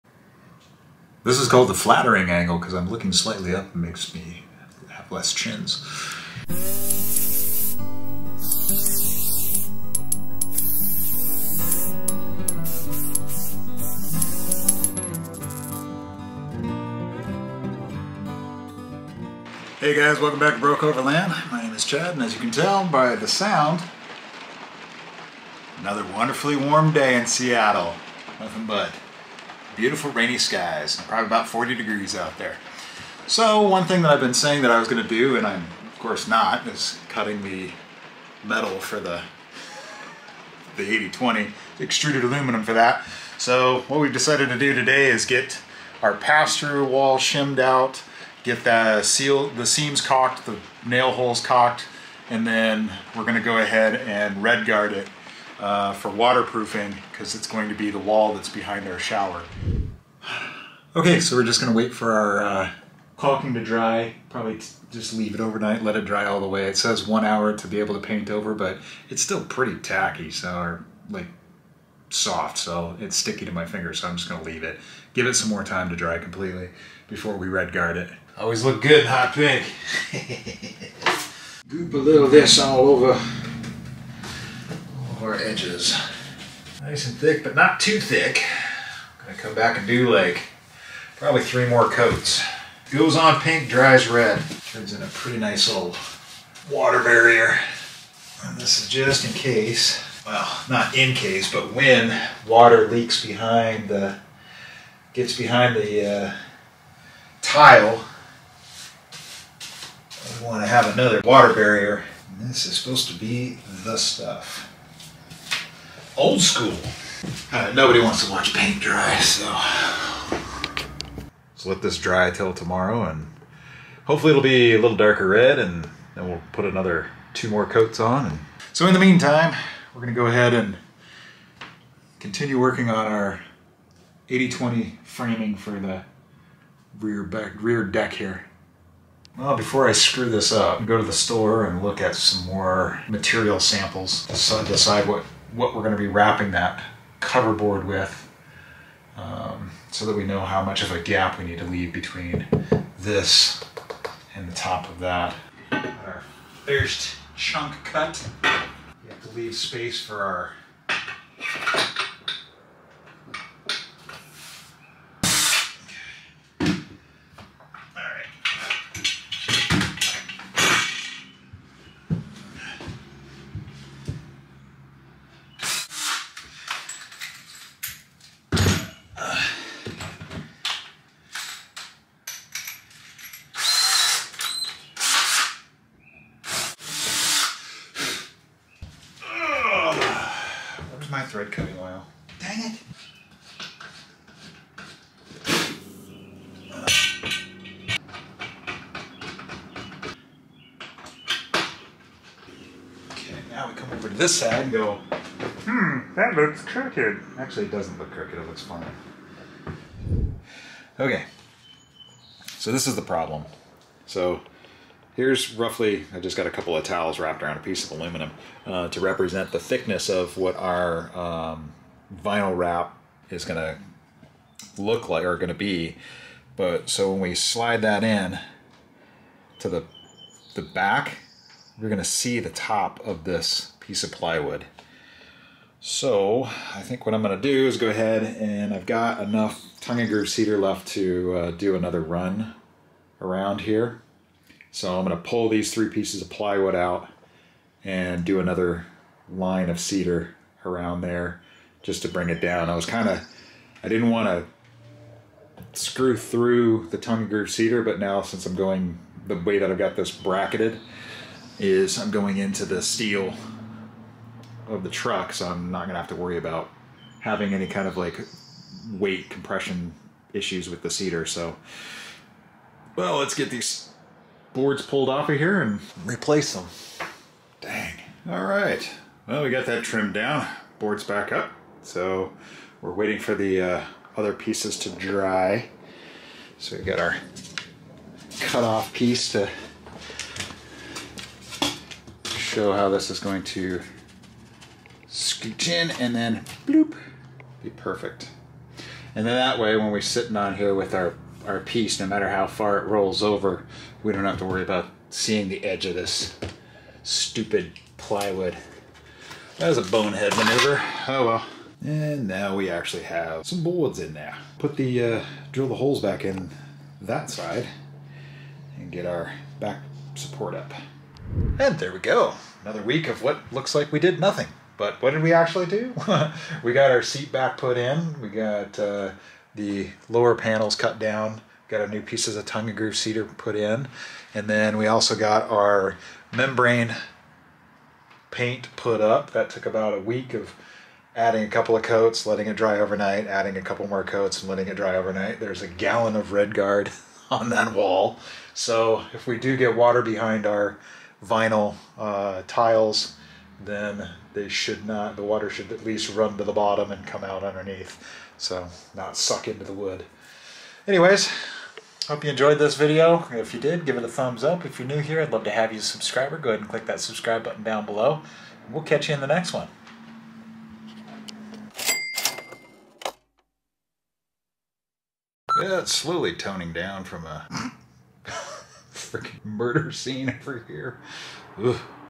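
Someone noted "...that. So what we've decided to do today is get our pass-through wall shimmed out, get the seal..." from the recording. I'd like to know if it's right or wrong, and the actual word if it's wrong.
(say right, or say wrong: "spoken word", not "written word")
right.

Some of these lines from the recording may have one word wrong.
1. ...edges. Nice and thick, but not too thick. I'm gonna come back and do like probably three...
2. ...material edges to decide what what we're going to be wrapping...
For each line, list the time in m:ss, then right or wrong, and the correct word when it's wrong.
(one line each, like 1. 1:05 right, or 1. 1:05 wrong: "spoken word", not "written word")
1. 1:25 right
2. 2:23 wrong: "samples", not "edges".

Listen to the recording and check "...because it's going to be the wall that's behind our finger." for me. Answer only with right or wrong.
wrong.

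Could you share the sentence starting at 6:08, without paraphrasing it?
We'll catch you in the next one.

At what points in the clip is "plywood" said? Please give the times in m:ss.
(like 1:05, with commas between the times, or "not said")
3:54, 4:06, 5:07.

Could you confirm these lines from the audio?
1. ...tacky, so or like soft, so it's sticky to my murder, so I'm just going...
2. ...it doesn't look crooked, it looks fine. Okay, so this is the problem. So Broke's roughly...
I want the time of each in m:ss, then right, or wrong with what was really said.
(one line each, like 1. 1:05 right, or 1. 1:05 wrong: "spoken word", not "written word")
1. 1:09 wrong: "finger", not "murder"
2. 3:27 wrong: "Here", not "Broke".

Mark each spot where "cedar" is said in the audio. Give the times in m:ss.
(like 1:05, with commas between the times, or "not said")
4:00, 4:09, 4:17, 4:30, 5:32.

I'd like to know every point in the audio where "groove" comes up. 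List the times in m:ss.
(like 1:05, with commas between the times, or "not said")
4:00, 4:17, 5:32.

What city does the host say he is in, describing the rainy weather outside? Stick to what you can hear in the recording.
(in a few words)
Seattle.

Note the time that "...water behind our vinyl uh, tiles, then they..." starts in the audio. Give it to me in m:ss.
5:49.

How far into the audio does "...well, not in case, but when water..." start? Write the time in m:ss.
1:40.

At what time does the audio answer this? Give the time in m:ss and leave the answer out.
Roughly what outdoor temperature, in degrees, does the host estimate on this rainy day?
0:31.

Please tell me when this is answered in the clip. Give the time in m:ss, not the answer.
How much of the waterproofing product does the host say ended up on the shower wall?
5:45.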